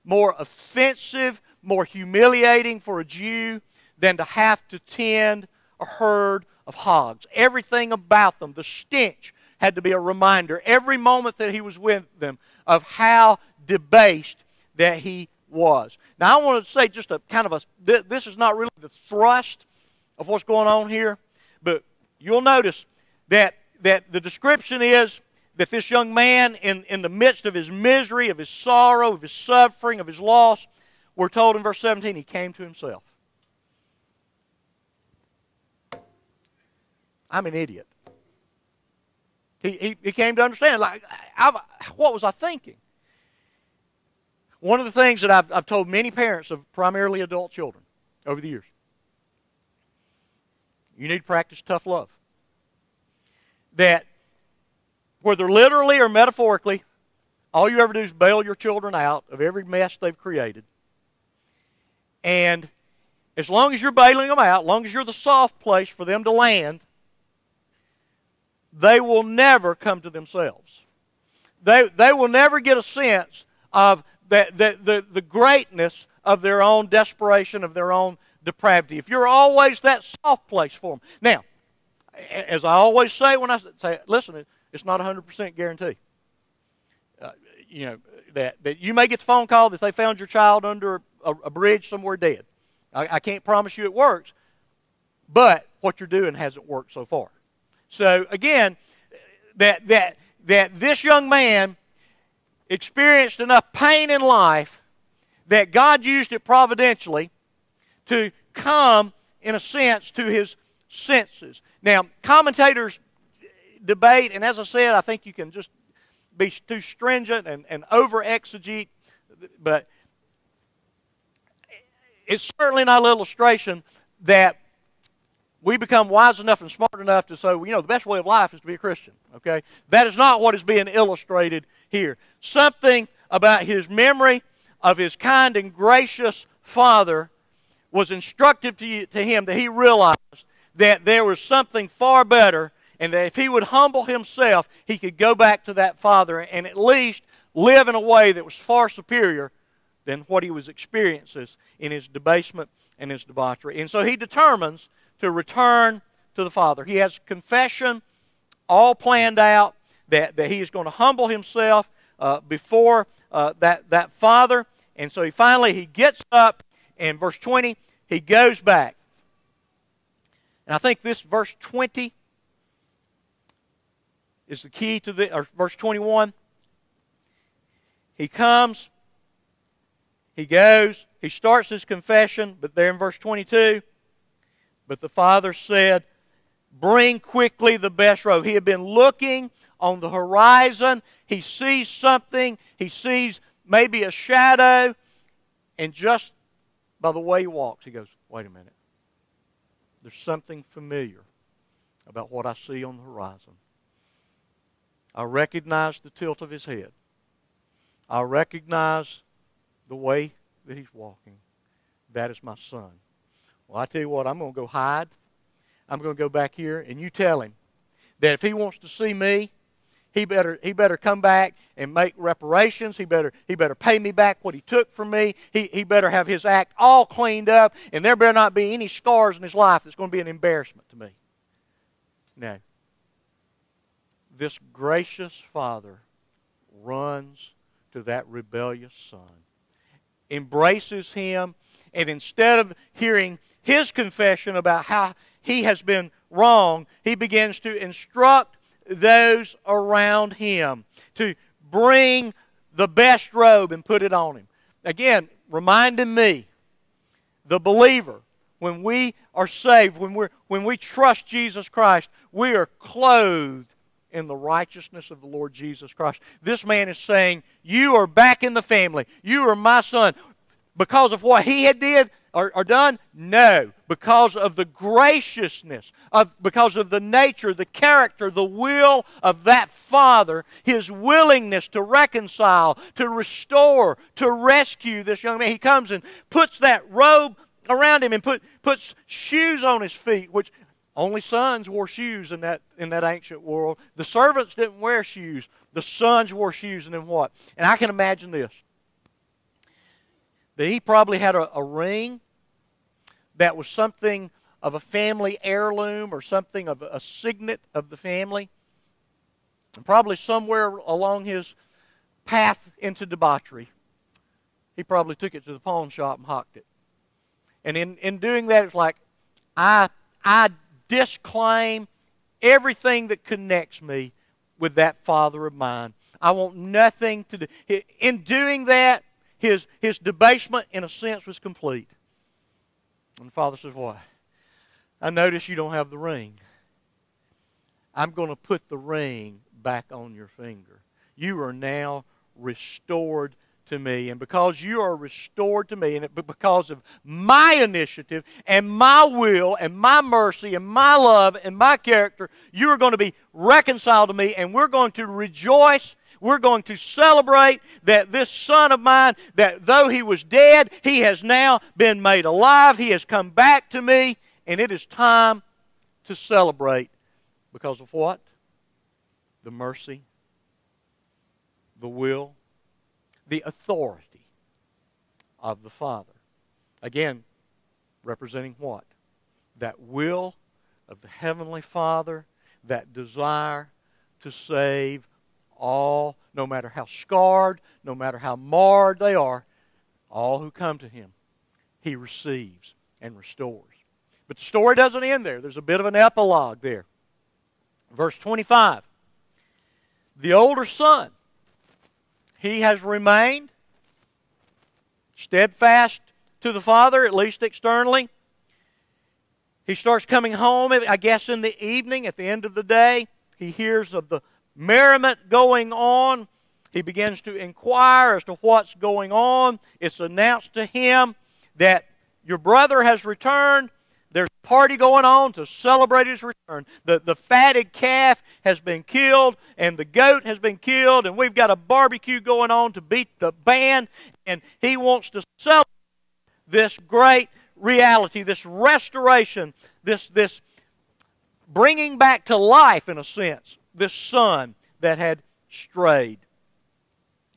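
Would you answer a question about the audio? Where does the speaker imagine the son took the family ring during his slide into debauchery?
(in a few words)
the pawn shop.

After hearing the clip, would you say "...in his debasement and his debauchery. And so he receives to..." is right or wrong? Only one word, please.
wrong.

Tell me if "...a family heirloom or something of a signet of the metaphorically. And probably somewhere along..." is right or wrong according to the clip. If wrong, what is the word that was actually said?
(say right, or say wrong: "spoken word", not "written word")
wrong: "family", not "metaphorically".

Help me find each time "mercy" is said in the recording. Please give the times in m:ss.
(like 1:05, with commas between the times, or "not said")
5:50, 6:09.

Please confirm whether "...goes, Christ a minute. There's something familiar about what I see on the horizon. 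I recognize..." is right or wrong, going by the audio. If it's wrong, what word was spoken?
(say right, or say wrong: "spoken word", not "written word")
wrong: "Wait", not "Christ".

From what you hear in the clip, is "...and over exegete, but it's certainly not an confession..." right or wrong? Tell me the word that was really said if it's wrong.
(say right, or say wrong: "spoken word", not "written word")
wrong: "illustration", not "confession".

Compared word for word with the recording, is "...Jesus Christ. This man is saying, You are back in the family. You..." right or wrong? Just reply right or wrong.
right.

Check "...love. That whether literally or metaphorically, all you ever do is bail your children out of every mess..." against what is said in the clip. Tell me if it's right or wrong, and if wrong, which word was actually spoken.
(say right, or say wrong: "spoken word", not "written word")
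right.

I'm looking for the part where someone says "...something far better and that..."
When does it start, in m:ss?
2:21.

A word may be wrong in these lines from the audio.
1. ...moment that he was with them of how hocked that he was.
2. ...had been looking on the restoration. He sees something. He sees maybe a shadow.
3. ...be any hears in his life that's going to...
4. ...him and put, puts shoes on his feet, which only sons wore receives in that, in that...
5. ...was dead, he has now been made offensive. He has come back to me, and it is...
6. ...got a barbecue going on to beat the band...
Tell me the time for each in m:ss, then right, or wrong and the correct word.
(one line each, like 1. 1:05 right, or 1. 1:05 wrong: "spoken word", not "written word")
1. 0:10 wrong: "debased", not "hocked"
2. 3:08 wrong: "horizon", not "restoration"
3. 3:48 wrong: "scars", not "hears"
4. 4:48 wrong: "shoes", not "receives"
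5. 6:00 wrong: "alive", not "offensive"
6. 7:11 right.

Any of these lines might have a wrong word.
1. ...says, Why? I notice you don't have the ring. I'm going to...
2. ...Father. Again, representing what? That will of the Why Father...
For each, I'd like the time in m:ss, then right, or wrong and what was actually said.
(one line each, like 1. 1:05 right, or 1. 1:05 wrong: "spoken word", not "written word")
1. 5:33 right
2. 6:15 wrong: "Heavenly", not "Why".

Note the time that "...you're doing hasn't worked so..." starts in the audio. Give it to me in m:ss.
1:35.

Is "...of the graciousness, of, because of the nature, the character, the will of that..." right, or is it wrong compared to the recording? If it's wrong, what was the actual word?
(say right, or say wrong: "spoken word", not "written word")
right.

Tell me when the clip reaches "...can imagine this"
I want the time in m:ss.
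4:57.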